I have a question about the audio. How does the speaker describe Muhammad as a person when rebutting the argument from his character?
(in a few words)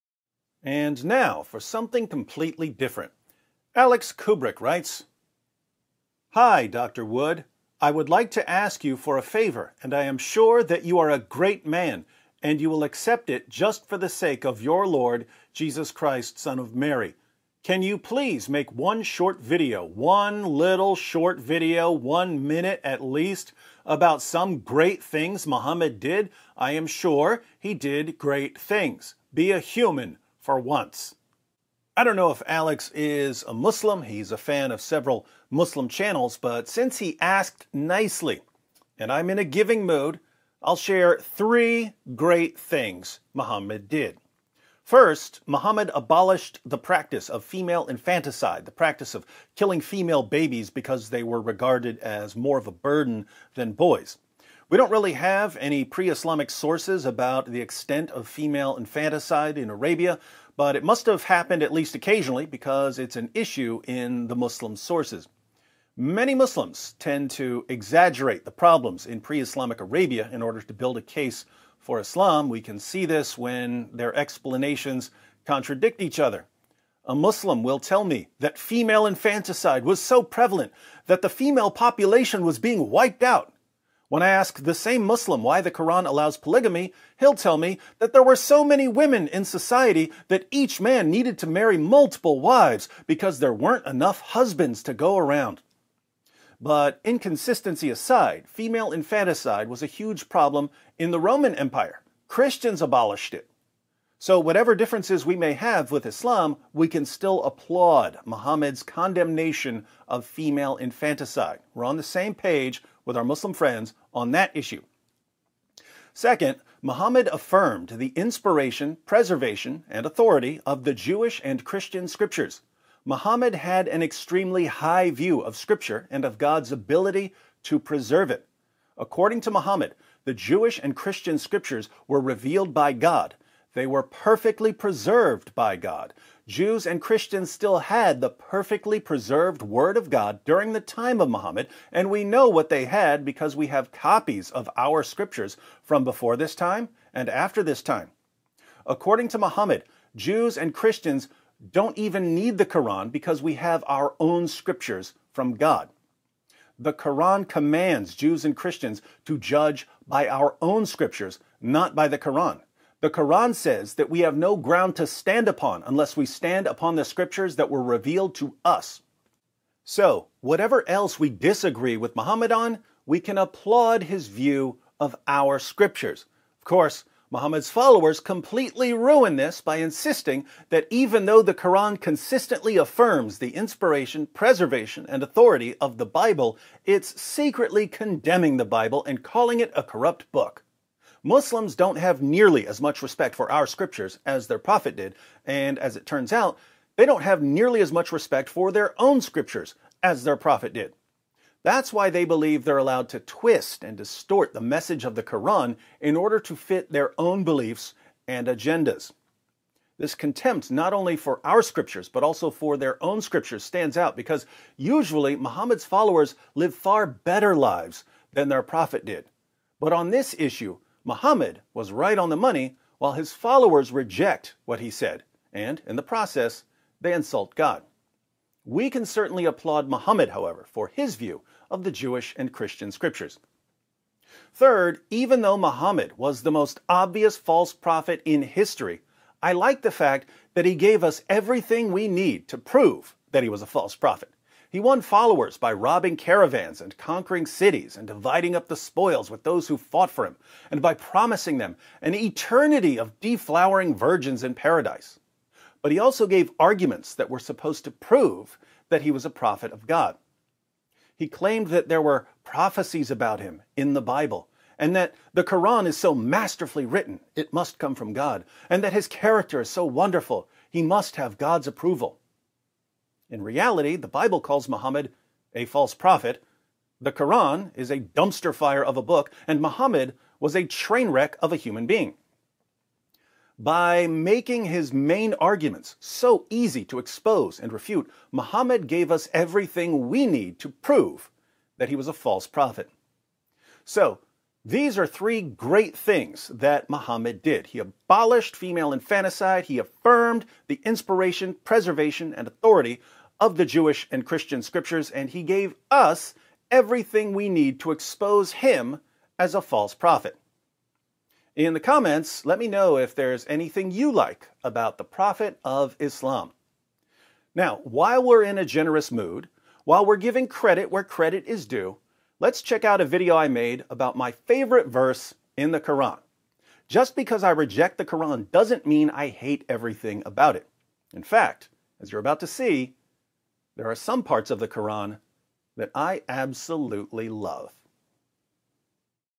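train wreck.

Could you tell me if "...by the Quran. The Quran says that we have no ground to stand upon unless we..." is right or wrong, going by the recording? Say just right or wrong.
right.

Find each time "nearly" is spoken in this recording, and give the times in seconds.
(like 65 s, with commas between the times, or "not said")
192 s, 197 s.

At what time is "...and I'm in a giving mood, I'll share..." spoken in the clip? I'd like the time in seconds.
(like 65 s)
38 s.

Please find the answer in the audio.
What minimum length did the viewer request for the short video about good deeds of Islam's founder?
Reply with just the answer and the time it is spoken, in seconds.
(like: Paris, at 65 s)
one minute, at 21 s.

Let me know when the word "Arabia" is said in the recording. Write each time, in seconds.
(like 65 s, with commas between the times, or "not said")
59 s, 69 s.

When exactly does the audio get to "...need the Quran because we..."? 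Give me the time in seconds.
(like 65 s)
152 s.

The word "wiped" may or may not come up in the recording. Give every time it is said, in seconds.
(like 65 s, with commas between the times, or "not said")
82 s.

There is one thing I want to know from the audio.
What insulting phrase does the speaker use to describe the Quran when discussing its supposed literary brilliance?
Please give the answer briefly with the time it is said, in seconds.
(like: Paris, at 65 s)
dumpster fire, at 278 s.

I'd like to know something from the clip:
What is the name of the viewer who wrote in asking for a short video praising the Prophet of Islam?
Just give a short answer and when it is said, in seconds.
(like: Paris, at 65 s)
Alex Kubrick, at 3 s.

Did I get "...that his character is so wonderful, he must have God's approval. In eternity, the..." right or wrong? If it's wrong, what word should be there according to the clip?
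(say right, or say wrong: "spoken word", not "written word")
wrong: "reality", not "eternity".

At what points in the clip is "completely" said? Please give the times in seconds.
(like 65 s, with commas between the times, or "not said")
2 s, 178 s.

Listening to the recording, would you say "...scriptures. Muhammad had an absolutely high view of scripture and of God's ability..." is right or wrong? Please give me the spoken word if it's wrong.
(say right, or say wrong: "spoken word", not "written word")
wrong: "extremely", not "absolutely".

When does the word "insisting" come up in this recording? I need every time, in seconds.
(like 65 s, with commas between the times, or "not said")
179 s.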